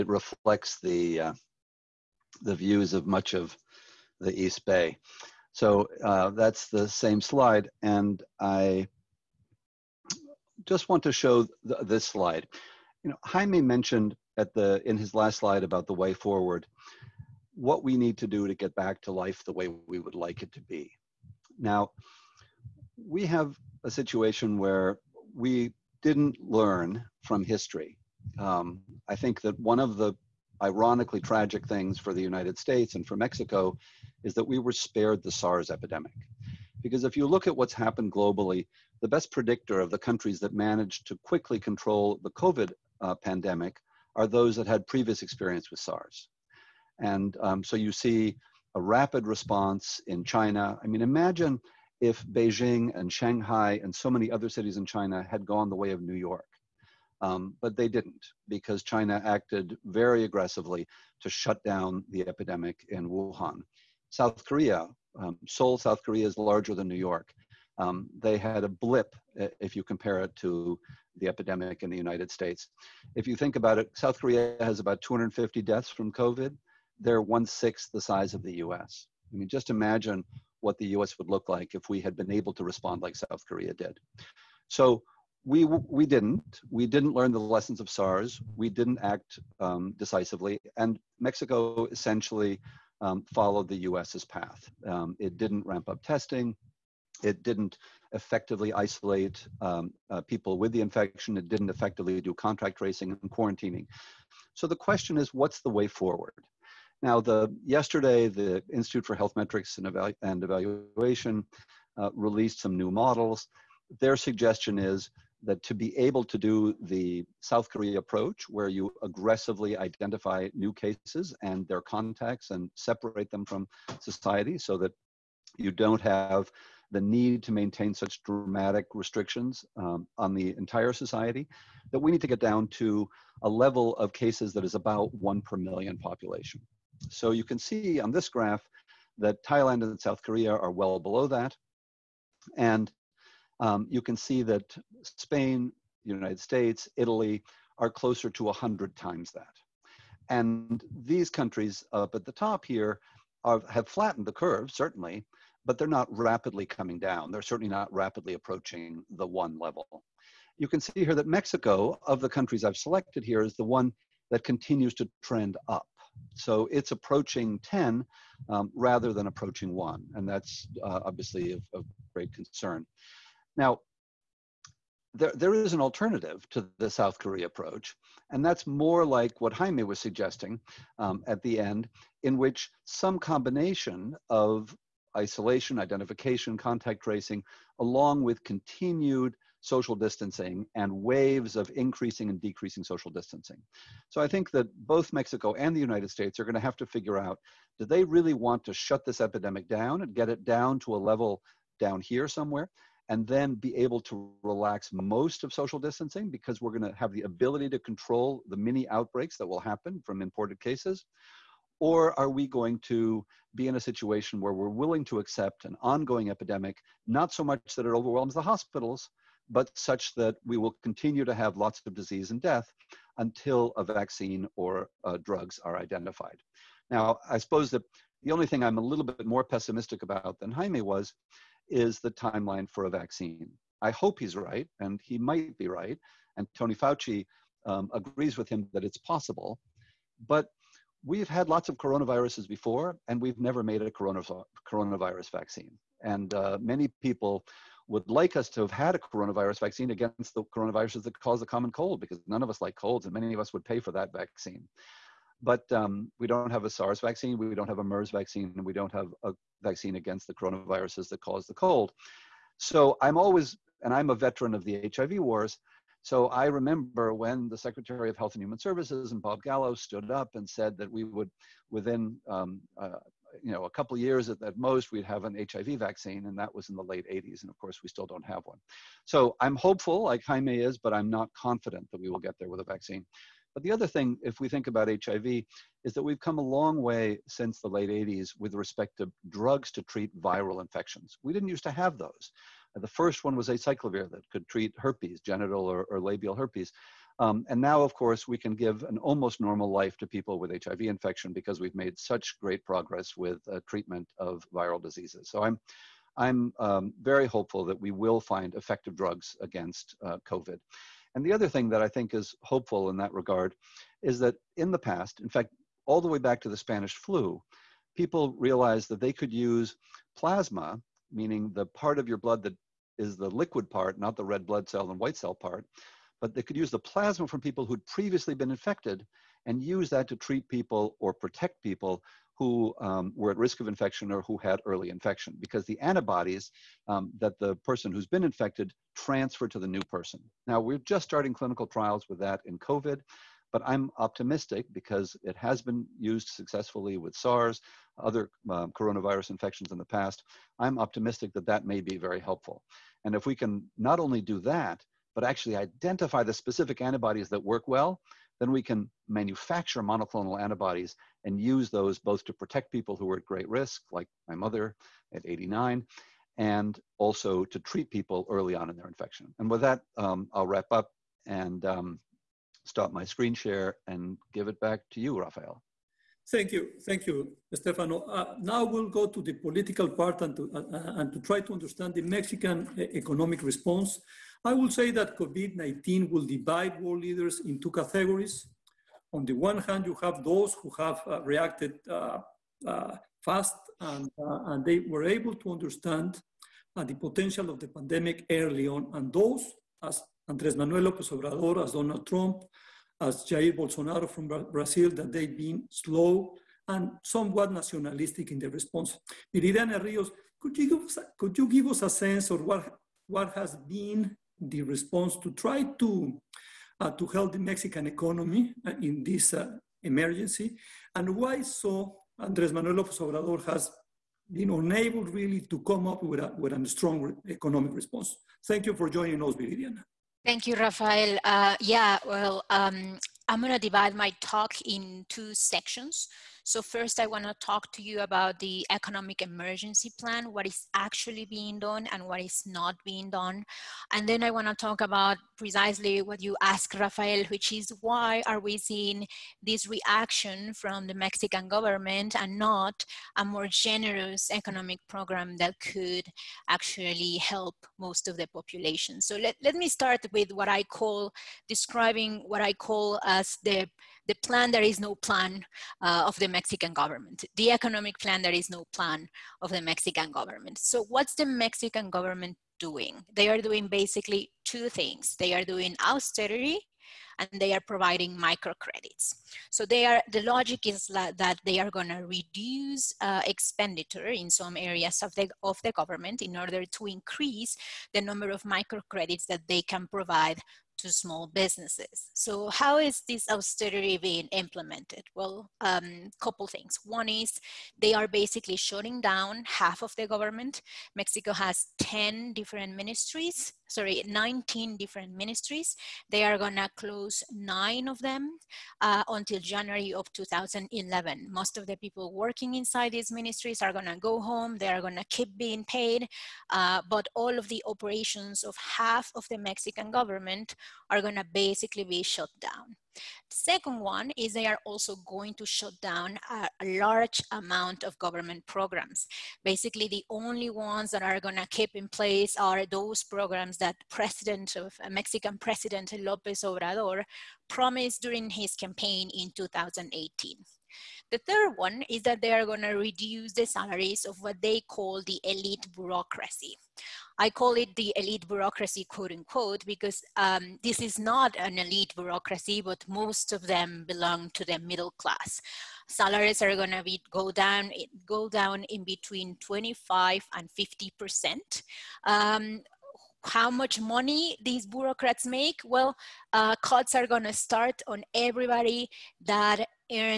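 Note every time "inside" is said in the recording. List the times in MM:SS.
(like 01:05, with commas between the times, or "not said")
08:32.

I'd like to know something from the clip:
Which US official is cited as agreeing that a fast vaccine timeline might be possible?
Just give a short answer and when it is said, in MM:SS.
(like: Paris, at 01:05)
Tony Fauci, at 03:56.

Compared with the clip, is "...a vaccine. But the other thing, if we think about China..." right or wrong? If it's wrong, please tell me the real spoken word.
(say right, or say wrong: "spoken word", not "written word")
wrong: "HIV", not "China".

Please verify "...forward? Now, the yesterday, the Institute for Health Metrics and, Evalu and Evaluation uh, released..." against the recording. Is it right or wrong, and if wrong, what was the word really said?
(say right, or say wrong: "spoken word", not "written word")
right.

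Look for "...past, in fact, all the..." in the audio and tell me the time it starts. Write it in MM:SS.
05:14.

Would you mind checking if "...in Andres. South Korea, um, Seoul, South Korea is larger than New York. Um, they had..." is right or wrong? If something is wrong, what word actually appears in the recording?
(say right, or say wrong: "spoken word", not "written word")
wrong: "Wuhan", not "Andres".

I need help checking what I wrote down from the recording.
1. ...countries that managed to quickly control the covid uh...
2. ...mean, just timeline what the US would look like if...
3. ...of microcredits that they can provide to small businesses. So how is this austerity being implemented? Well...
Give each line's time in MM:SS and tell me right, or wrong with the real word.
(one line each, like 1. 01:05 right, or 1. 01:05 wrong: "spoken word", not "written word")
1. 00:39 right
2. 01:19 wrong: "imagine", not "timeline"
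3. 08:08 right.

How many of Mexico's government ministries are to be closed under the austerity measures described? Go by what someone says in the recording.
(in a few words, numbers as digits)
9.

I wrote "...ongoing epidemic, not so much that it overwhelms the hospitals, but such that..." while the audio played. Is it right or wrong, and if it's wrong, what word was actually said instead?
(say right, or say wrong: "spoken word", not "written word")
right.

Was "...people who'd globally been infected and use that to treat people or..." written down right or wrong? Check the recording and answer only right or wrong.
wrong.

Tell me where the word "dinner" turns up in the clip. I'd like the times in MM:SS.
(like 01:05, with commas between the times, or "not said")
not said.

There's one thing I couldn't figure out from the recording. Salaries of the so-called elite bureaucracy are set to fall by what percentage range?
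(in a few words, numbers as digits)
25 to 50 percent.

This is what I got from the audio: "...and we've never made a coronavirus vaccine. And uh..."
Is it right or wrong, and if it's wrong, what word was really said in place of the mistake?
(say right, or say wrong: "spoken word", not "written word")
right.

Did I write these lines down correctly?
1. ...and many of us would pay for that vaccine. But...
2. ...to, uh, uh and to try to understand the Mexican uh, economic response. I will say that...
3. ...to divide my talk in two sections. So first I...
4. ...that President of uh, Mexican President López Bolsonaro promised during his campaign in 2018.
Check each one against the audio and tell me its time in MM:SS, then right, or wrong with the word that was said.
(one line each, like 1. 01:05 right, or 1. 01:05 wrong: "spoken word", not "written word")
1. 04:13 right
2. 06:20 right
3. 07:13 right
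4. 08:53 wrong: "Obrador", not "Bolsonaro".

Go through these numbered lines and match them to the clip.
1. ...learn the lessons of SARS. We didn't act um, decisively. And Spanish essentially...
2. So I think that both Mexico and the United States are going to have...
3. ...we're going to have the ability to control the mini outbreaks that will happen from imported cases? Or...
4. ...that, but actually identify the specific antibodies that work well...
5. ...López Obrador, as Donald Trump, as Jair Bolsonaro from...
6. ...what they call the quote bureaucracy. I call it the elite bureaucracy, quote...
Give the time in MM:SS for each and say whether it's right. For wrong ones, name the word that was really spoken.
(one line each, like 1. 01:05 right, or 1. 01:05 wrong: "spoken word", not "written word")
1. 01:27 wrong: "Mexico", not "Spanish"
2. 03:14 right
3. 03:26 right
4. 05:54 right
5. 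06:40 right
6. 09:04 wrong: "elite", not "quote".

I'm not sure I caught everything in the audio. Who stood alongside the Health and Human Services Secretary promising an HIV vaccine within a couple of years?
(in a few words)
Bob Gallo.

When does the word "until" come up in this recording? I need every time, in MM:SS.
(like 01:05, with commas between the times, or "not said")
03:43, 08:29.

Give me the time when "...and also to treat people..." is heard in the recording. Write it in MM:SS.
06:06.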